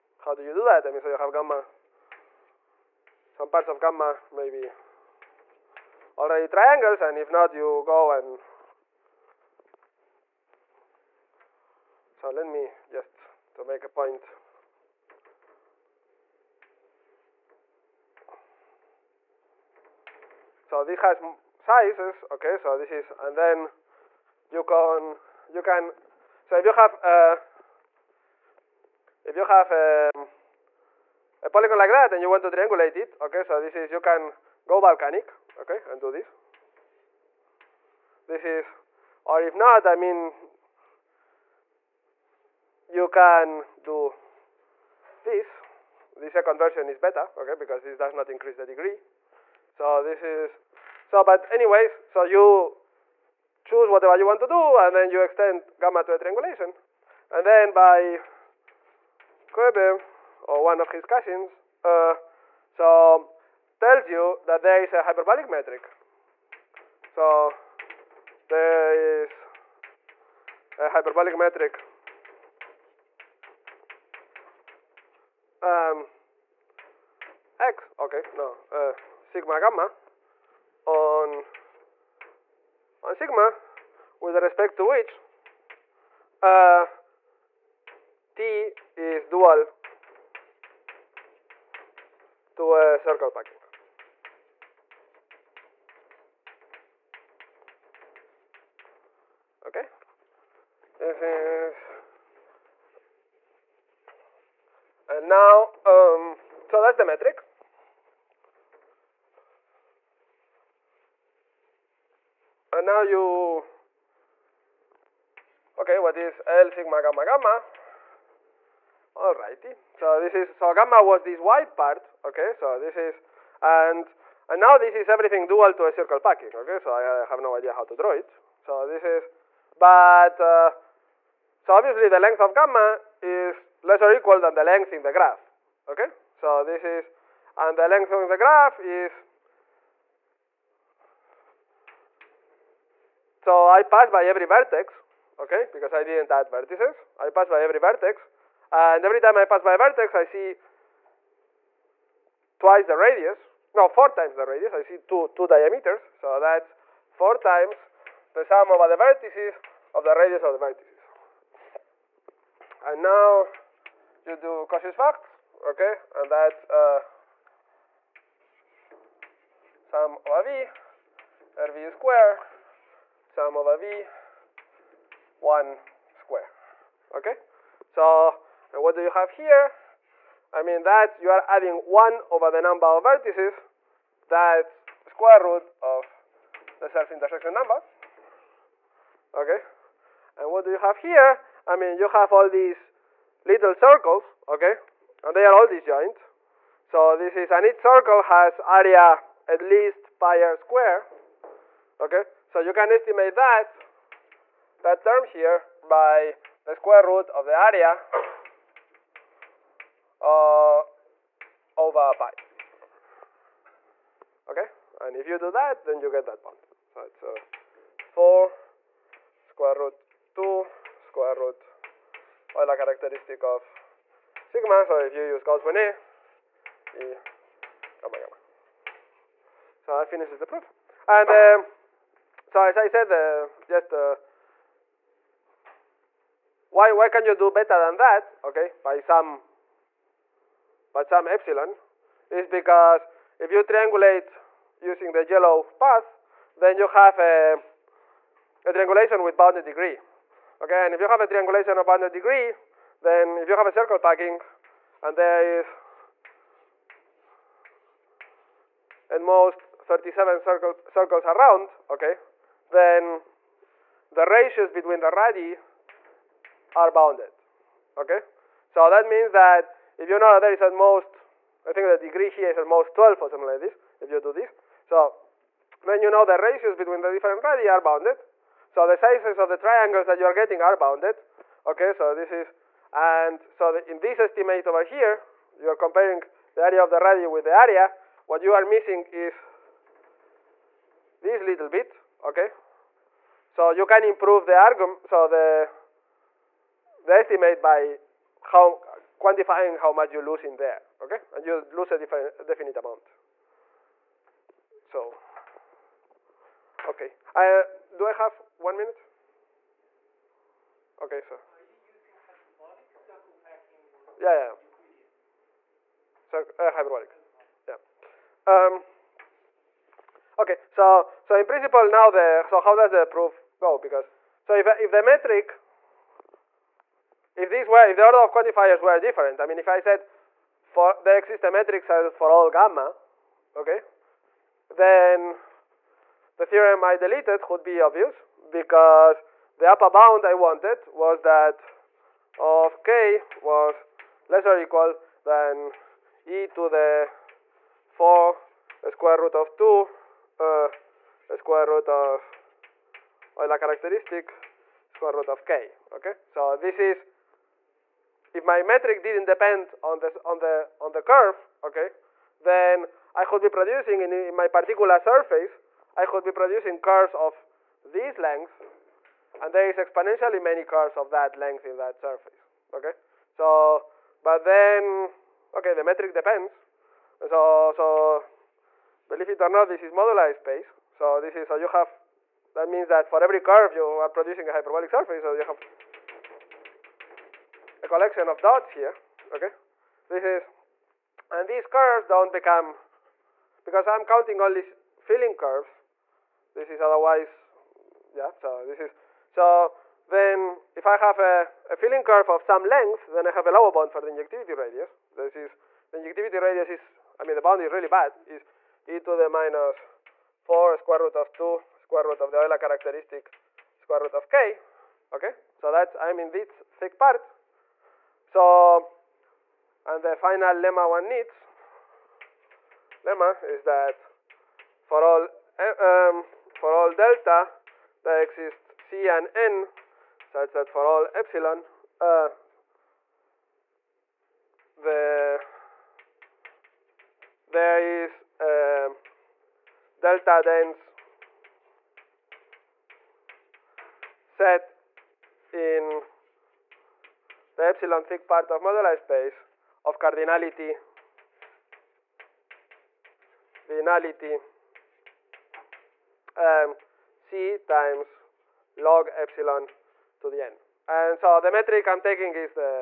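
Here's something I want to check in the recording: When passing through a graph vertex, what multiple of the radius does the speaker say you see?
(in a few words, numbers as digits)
4.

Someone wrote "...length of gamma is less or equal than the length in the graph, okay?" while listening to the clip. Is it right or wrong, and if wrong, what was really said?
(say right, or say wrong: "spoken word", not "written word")
right.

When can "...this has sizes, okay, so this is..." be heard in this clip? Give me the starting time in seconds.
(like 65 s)
20 s.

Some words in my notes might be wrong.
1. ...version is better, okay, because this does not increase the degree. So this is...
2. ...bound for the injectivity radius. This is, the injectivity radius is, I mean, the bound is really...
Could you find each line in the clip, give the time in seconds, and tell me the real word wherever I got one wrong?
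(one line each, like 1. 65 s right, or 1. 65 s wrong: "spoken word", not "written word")
1. 46 s right
2. 403 s right.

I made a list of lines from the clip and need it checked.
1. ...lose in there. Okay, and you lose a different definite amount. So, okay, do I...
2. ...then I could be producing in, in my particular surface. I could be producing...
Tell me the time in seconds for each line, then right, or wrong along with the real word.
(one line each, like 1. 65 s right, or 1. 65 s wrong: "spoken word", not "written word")
1. 300 s right
2. 362 s right.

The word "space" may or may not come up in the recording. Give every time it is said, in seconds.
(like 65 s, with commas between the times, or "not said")
380 s, 448 s.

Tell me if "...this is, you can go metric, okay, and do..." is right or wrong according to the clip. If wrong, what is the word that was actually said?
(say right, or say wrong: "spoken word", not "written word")
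wrong: "volcanic", not "metric".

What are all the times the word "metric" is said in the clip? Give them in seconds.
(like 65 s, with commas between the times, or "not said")
65 s, 71 s, 107 s, 325 s, 331 s, 358 s, 375 s, 461 s.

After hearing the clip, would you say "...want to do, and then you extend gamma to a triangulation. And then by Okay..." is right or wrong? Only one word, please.
wrong.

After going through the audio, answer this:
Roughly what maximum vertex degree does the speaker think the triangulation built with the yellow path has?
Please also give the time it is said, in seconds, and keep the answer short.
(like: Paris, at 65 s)
12, at 272 s.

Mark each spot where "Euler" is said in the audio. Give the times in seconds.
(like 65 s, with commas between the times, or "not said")
222 s, 353 s, 412 s.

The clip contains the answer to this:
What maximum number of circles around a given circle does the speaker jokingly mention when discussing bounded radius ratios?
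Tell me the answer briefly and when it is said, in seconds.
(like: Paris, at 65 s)
37, at 259 s.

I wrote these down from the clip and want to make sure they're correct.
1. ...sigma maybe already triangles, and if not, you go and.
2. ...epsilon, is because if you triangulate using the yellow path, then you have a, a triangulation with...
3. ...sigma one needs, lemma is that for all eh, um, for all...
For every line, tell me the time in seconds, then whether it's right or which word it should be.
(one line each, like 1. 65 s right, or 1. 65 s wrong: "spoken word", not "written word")
1. 3 s wrong: "gamma", not "sigma"
2. 241 s right
3. 420 s wrong: "lemma", not "sigma".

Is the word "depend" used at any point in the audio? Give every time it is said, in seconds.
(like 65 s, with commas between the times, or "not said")
359 s, 376 s.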